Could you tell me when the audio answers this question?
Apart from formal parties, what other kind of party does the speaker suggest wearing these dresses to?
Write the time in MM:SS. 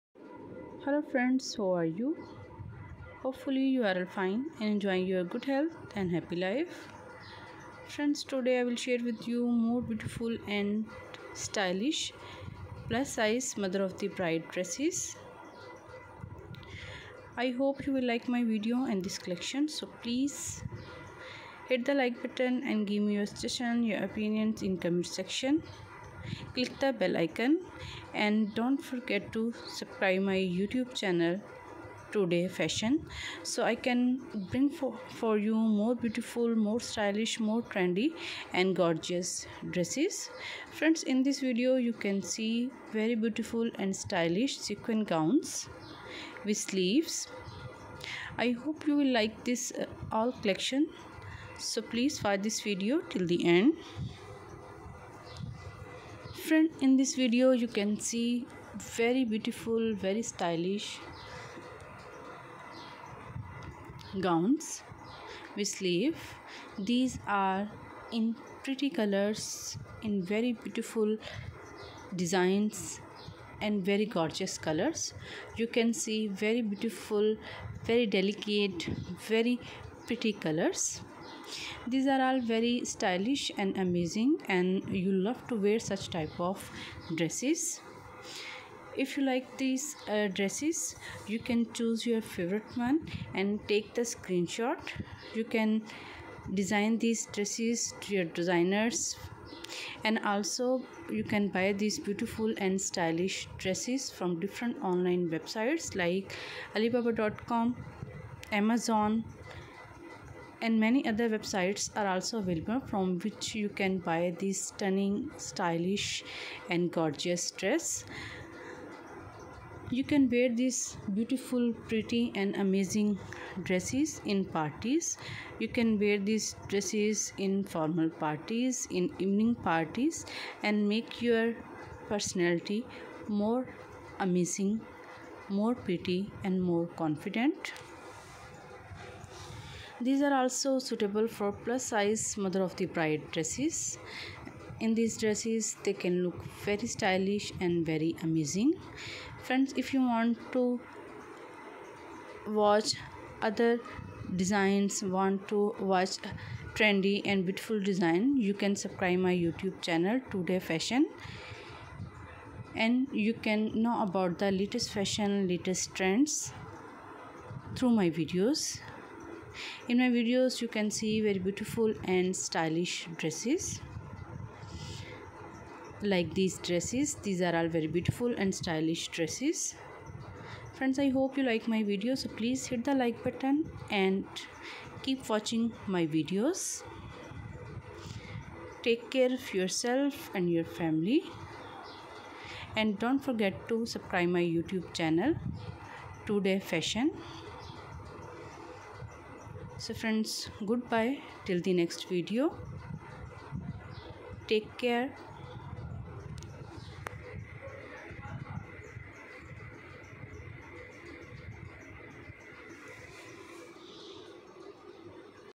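02:09.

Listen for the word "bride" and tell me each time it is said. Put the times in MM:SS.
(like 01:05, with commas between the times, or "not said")
00:14, 02:22.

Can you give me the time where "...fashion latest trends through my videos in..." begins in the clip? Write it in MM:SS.
02:44.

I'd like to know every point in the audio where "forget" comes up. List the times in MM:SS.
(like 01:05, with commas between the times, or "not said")
00:28, 03:13.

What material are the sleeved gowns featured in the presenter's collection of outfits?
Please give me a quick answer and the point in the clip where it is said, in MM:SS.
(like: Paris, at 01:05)
sequin, at 00:44.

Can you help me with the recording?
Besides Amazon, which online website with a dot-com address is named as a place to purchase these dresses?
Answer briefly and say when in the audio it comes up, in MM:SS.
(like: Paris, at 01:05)
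alibaba.com, at 01:46.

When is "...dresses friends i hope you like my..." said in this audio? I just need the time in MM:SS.
02:59.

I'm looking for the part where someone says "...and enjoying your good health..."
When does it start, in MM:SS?
00:04.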